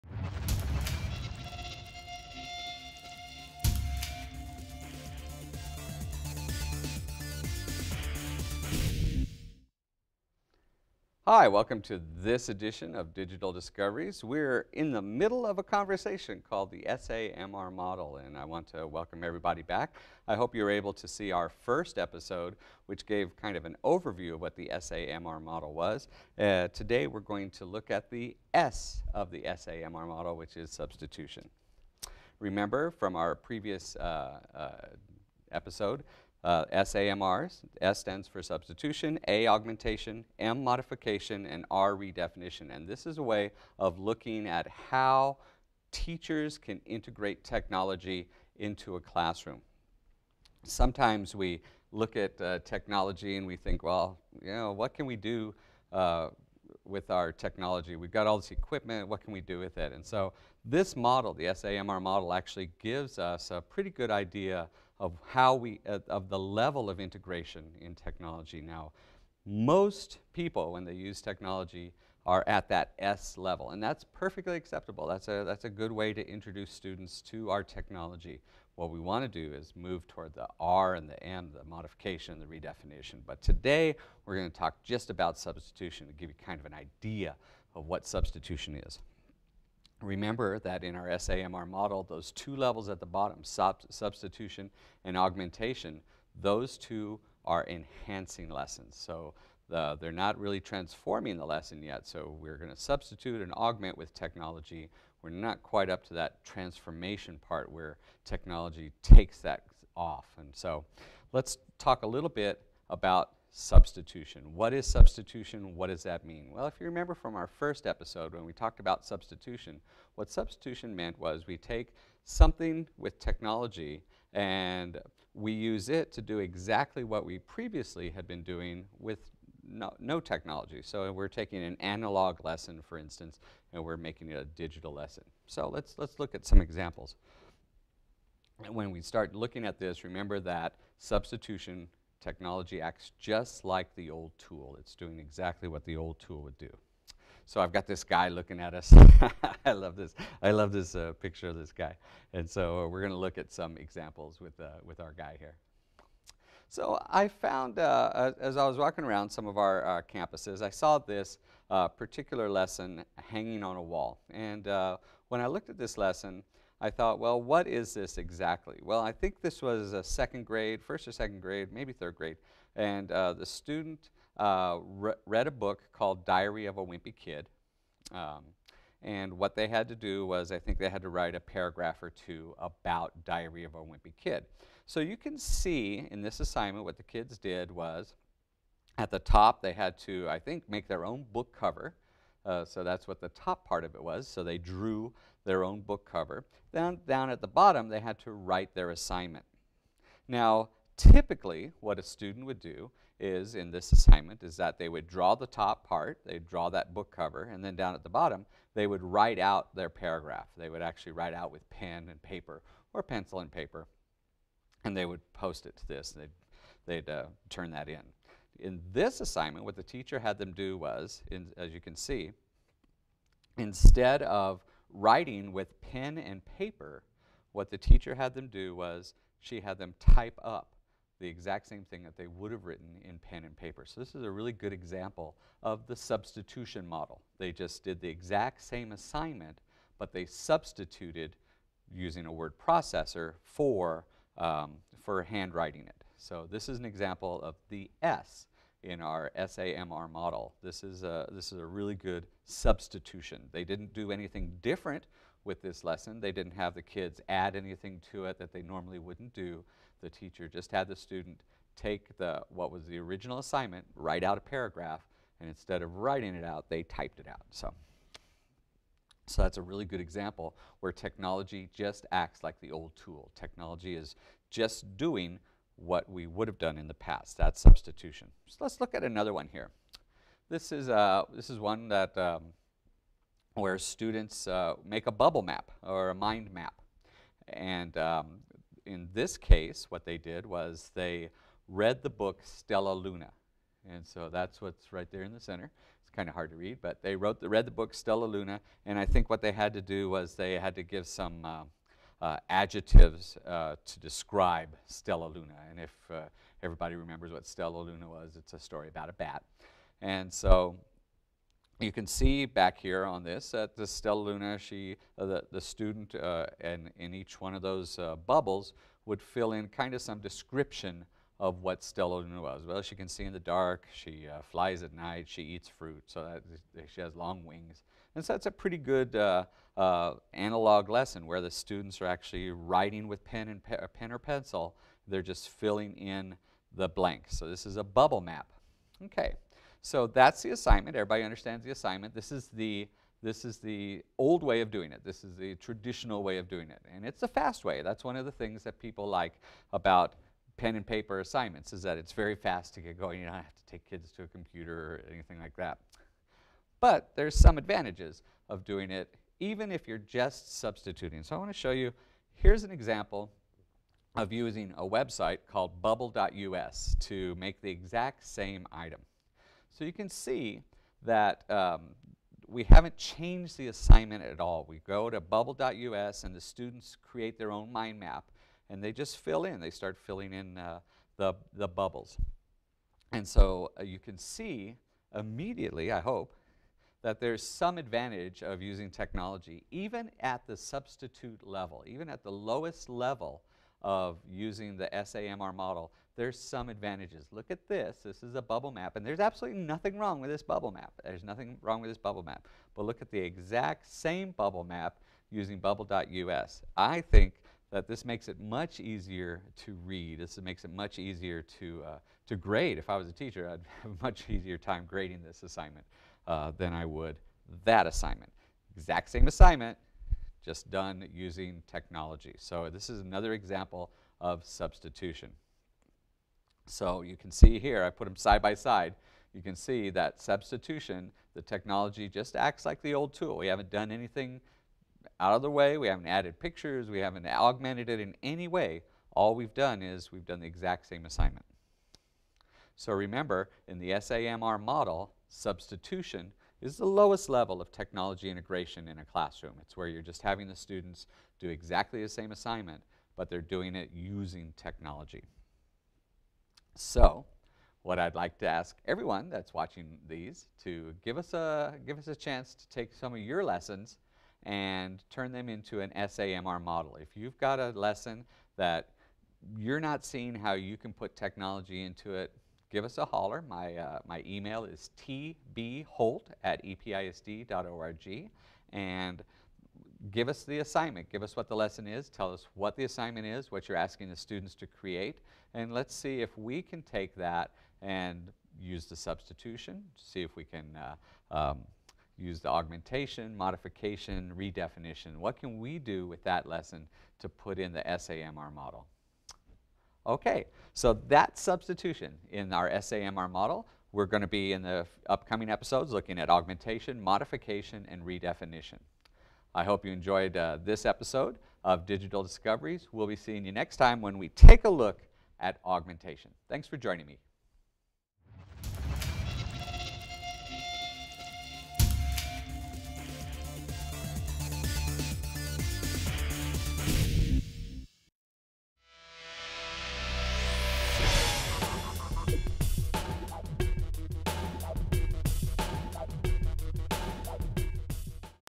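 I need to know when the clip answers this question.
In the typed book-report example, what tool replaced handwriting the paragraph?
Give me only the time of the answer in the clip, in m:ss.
4:02.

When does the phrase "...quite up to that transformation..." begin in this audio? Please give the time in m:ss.
1:45.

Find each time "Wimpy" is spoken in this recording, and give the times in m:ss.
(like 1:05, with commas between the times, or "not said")
2:56, 3:03.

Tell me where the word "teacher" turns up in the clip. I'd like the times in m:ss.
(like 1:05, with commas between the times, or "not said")
0:45, 3:39, 3:47, 4:20, 6:53.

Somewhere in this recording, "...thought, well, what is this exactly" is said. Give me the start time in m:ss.
2:46.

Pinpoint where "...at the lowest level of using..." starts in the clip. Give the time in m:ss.
6:32.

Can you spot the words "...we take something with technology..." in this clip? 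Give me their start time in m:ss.
2:01.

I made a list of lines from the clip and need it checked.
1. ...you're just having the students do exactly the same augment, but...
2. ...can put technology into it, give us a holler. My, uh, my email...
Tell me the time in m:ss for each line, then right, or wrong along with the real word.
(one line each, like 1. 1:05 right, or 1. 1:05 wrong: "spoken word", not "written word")
1. 7:29 wrong: "assignment", not "augment"
2. 7:50 right.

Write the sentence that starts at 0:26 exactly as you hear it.
Uh, today, we're going to look at the S of the SAMR model, which is substitution.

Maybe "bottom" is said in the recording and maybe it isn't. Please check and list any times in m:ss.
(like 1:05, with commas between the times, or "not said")
1:33, 3:17, 3:28.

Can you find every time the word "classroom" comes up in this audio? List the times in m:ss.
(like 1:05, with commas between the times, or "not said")
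0:48, 7:29.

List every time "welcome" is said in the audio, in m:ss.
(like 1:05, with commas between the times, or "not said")
0:11, 0:18.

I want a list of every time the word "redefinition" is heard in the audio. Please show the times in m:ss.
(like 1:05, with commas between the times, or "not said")
0:41, 1:22, 8:14, 8:28.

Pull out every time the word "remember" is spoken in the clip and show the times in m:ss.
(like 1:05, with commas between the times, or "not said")
0:32, 1:30, 1:56, 2:20, 5:06, 7:22.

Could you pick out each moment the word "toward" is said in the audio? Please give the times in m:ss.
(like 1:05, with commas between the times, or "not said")
1:20.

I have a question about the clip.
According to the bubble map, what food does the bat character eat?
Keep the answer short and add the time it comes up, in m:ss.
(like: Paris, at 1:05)
Fruit, at 5:25.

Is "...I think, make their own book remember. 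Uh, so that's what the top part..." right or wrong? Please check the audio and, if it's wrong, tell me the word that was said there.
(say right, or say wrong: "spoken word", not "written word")
wrong: "cover", not "remember".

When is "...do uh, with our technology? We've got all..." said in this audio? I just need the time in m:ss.
0:55.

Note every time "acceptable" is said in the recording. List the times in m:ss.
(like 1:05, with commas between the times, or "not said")
1:14.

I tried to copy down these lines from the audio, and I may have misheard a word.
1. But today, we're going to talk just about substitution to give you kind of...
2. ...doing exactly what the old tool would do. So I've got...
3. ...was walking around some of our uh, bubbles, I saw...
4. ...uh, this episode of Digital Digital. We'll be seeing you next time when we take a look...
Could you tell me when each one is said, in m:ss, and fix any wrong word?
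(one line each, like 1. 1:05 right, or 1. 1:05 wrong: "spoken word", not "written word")
1. 1:23 right
2. 2:24 right
3. 2:38 wrong: "campuses", not "bubbles"
4. 8:30 wrong: "Discoveries", not "Digital".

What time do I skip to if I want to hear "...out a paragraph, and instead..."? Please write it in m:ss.
4:24.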